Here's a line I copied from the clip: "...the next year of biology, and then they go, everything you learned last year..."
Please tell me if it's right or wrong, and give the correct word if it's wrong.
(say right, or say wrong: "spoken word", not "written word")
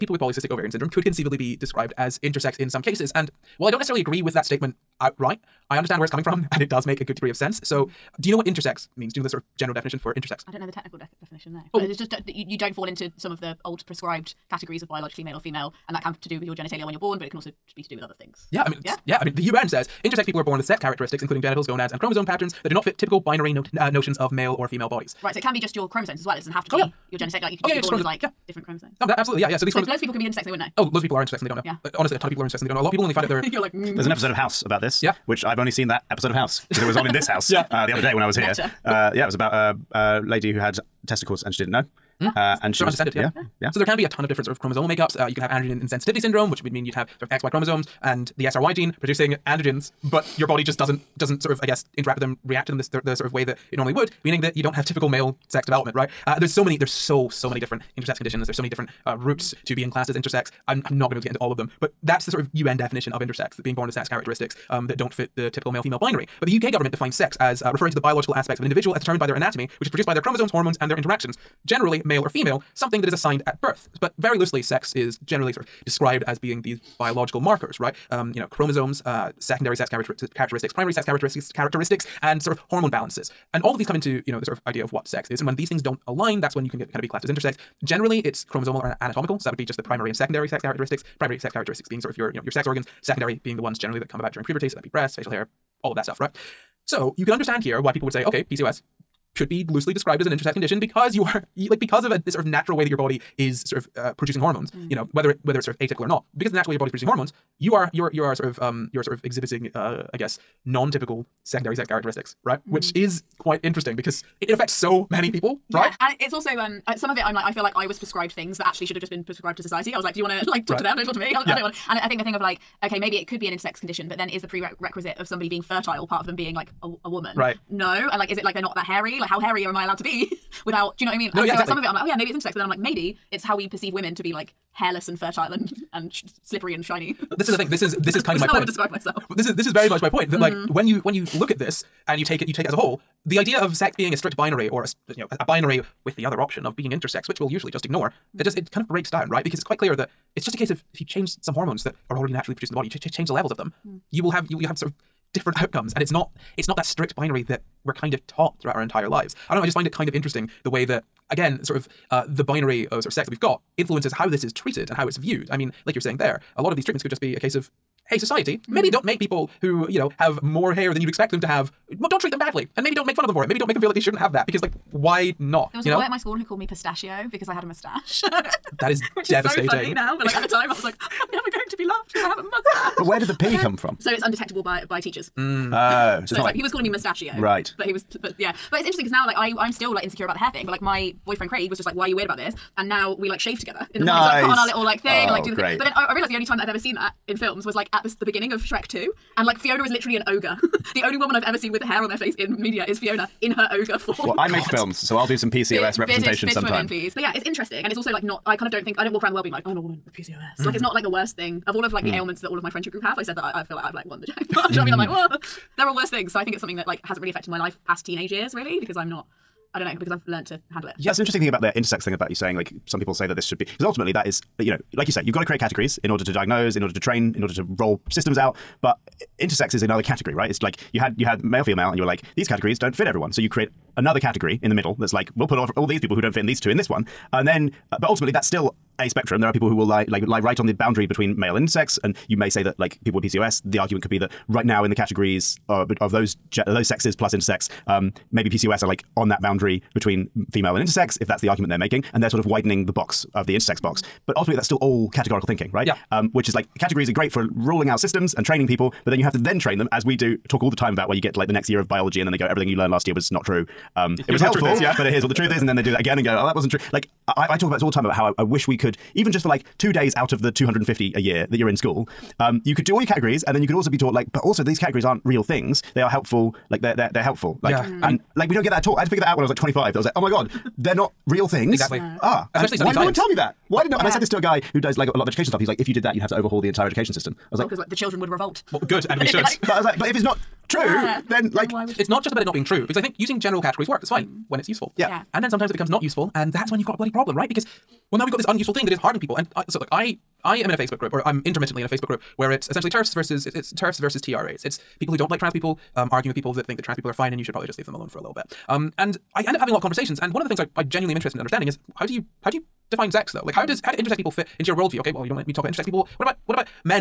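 right.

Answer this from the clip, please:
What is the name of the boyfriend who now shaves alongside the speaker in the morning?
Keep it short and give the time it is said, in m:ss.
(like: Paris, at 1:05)
Craig, at 3:11.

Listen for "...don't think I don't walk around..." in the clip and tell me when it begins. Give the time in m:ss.
3:28.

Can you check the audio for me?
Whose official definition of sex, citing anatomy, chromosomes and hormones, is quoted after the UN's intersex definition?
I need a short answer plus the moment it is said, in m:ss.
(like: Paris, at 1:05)
UK government, at 1:06.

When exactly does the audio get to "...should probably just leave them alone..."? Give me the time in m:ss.
5:07.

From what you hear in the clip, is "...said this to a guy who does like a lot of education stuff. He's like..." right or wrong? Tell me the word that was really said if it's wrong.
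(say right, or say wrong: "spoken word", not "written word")
right.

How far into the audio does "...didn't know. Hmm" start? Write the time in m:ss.
0:41.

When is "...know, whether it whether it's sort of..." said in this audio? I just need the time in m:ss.
1:44.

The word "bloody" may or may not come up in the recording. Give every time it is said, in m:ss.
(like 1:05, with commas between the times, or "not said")
4:56.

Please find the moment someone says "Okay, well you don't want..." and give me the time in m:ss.
5:15.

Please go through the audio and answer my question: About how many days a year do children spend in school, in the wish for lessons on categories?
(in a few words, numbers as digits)
250.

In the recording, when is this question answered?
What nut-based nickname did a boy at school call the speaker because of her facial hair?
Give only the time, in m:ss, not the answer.
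2:56.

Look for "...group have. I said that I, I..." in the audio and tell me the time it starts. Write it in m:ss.
3:32.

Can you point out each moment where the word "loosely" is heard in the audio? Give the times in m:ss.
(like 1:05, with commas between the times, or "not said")
1:14, 1:39.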